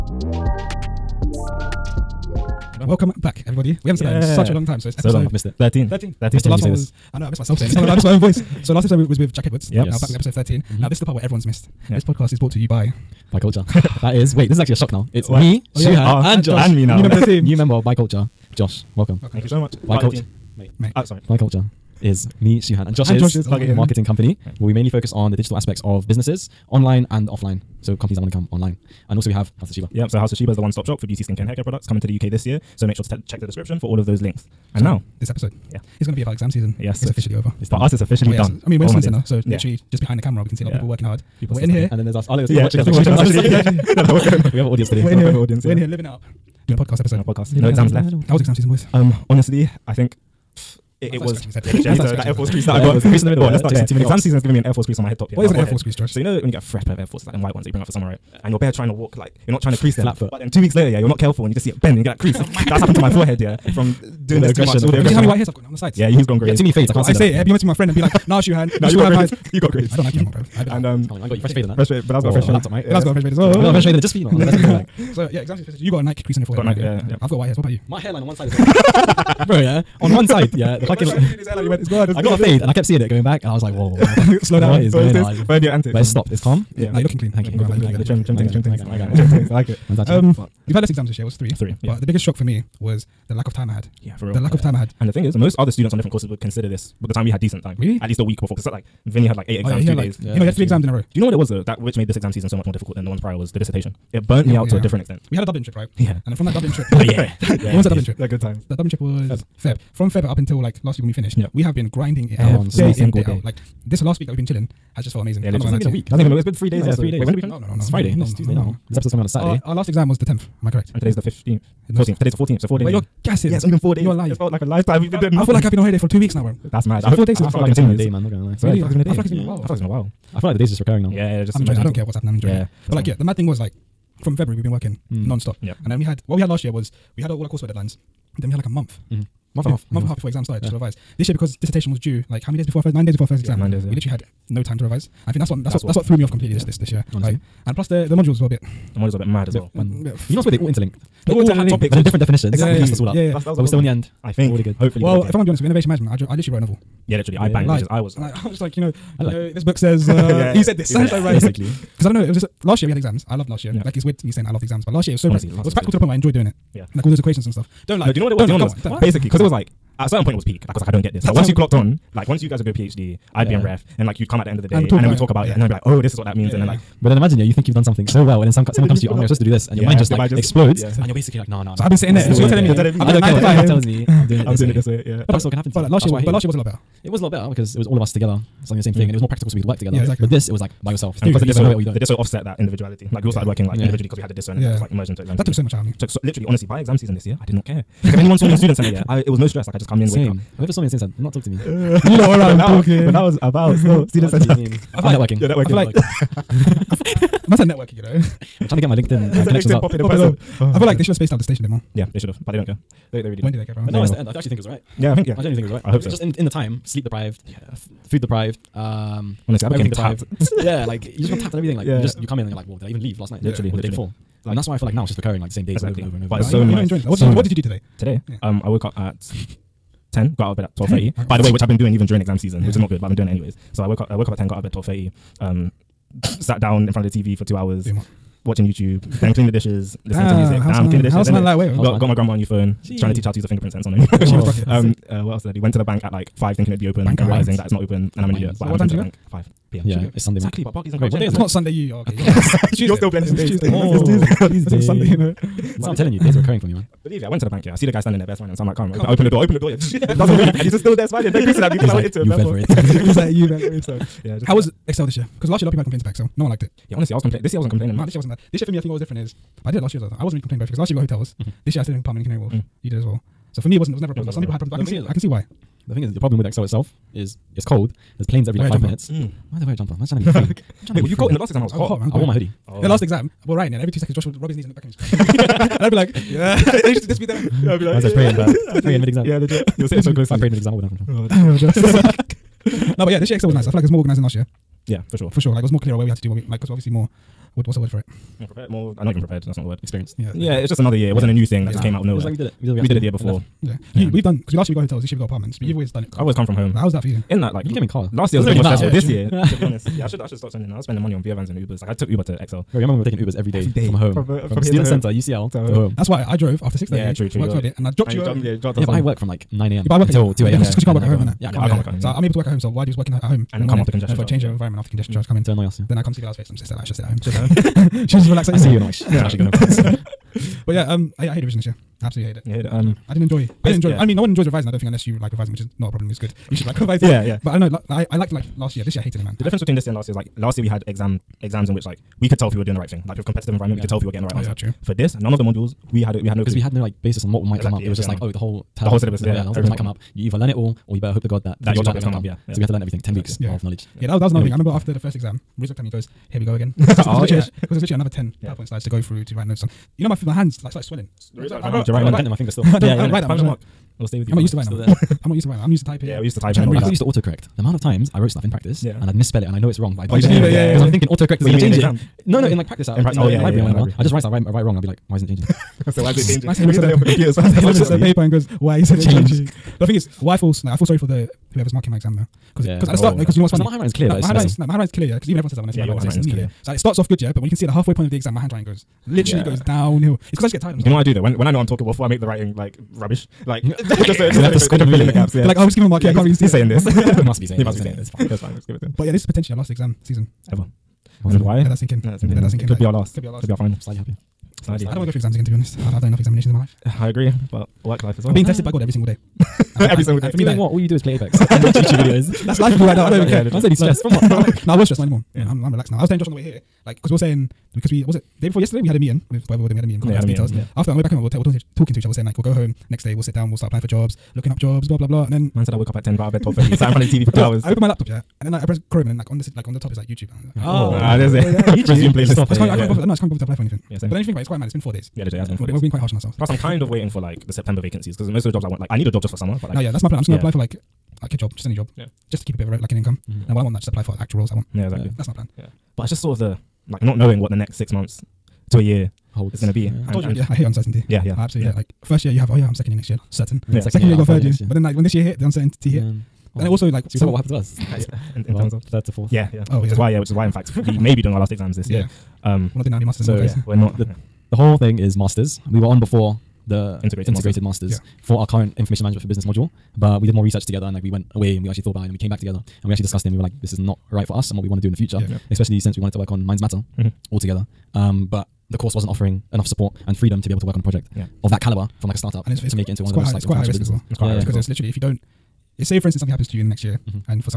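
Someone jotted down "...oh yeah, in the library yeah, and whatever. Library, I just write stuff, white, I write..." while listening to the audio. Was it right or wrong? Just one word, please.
wrong.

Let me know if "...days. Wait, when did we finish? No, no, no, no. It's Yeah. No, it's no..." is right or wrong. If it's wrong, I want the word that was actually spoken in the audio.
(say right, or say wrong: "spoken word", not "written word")
wrong: "Friday", not "Yeah".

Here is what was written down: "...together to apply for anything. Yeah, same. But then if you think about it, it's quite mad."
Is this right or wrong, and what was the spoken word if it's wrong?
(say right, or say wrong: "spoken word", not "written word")
wrong: "bother", not "together".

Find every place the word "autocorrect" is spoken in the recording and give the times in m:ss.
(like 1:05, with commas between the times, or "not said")
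6:07, 6:11.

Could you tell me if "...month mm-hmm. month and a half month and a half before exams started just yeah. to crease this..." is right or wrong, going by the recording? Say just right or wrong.
wrong.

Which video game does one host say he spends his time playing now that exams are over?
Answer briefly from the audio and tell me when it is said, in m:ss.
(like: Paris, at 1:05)
Apex, at 6:51.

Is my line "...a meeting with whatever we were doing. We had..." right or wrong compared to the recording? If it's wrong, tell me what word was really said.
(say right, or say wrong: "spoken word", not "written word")
right.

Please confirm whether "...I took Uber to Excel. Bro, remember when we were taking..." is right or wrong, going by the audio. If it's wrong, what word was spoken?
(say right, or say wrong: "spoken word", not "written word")
right.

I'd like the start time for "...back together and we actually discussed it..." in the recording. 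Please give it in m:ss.
7:52.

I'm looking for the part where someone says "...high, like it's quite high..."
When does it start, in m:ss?
8:03.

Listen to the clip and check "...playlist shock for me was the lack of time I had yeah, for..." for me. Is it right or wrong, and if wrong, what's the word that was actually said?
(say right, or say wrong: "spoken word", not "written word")
wrong: "biggest", not "playlist".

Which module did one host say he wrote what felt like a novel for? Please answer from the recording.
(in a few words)
Innovation management.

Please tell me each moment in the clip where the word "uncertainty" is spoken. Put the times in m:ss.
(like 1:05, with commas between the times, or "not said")
7:30, 7:35.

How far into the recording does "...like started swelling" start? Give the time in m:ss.
6:00.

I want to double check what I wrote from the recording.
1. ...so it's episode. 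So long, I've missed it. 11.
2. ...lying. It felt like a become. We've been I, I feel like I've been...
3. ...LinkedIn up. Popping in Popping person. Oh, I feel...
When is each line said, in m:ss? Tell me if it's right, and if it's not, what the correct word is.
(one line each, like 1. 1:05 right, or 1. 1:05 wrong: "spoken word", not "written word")
1. 0:04 wrong: "13", not "11"
2. 2:04 wrong: "lifetime", not "become"
3. 3:29 right.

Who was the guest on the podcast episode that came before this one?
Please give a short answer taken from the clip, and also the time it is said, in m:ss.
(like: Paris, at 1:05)
Jack Edwards, at 0:09.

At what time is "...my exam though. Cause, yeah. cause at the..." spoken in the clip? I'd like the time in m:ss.
6:21.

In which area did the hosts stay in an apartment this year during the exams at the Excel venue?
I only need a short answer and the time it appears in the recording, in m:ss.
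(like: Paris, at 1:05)
Canary Wharf, at 4:32.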